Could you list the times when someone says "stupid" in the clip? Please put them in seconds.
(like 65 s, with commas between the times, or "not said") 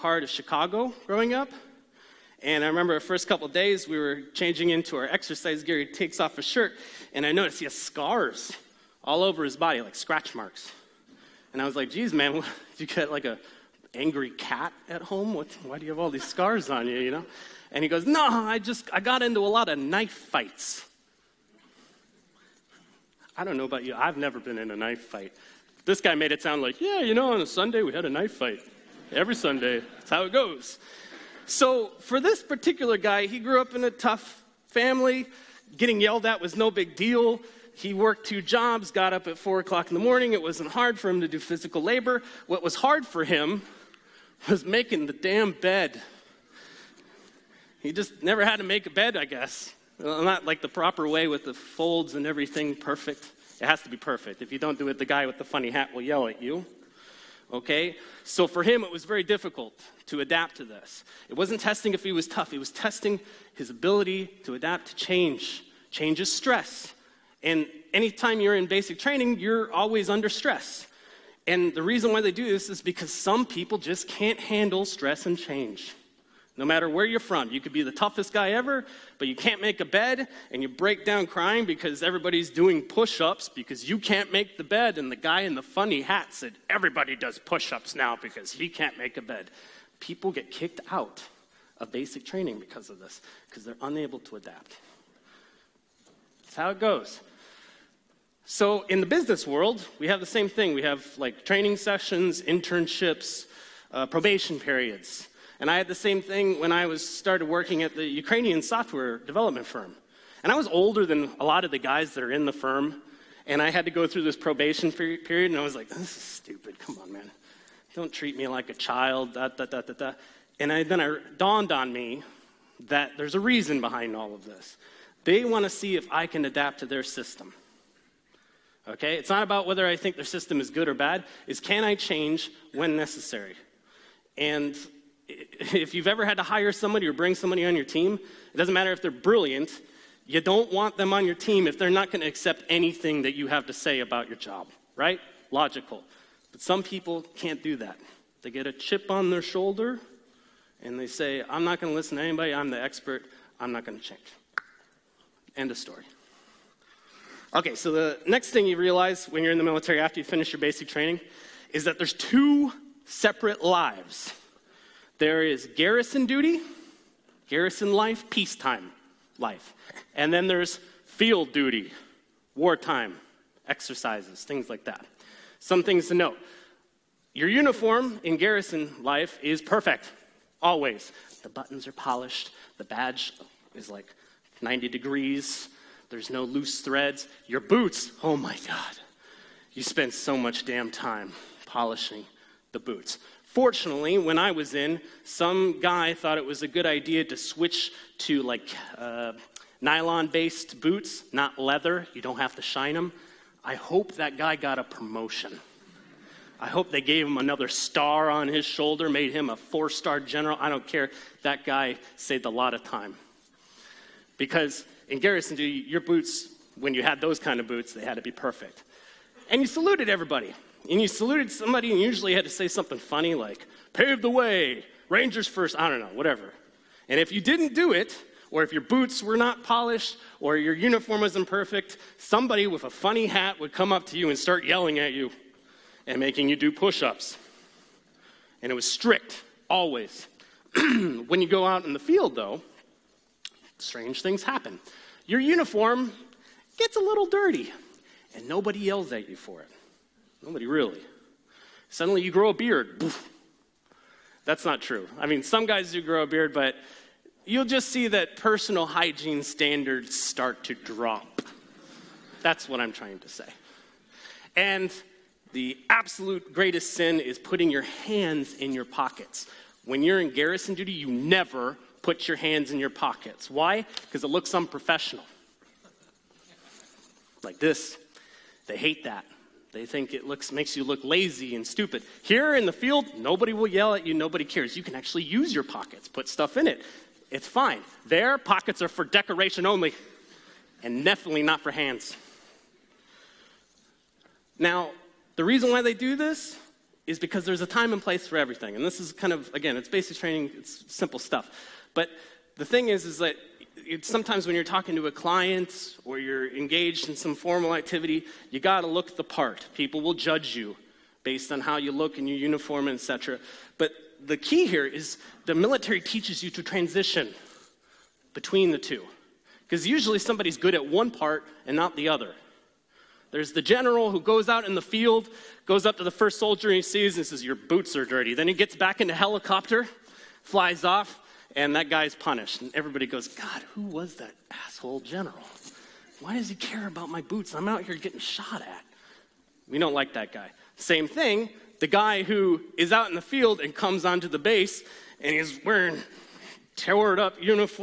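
116 s, 281 s.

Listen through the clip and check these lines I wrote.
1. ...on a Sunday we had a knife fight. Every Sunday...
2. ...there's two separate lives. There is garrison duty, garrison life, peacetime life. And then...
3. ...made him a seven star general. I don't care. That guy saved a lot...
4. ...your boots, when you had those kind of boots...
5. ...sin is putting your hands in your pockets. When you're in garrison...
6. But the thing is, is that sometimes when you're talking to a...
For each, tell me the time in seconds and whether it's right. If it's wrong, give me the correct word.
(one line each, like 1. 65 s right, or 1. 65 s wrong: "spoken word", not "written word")
1. 27 s right
2. 161 s right
3. 209 s wrong: "four", not "seven"
4. 215 s right
5. 266 s right
6. 301 s right.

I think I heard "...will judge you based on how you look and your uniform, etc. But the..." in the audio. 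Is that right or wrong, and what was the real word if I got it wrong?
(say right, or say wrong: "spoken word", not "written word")
right.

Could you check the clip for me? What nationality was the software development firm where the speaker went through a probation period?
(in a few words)
Ukrainian.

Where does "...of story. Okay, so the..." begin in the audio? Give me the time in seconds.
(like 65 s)
155 s.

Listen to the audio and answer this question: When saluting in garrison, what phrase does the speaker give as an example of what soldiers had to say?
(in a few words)
Rangers first.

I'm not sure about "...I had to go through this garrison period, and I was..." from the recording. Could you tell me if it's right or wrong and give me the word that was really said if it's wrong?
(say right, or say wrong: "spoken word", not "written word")
wrong: "probation", not "garrison".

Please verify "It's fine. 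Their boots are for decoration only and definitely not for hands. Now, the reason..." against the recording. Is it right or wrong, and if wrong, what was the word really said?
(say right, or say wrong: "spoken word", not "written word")
wrong: "pockets", not "boots".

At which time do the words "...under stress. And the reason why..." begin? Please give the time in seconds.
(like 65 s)
70 s.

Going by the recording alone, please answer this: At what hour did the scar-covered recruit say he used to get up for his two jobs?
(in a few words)
4 o'clock.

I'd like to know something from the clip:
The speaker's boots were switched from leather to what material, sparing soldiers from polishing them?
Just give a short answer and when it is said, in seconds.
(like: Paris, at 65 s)
Nylon, at 199 s.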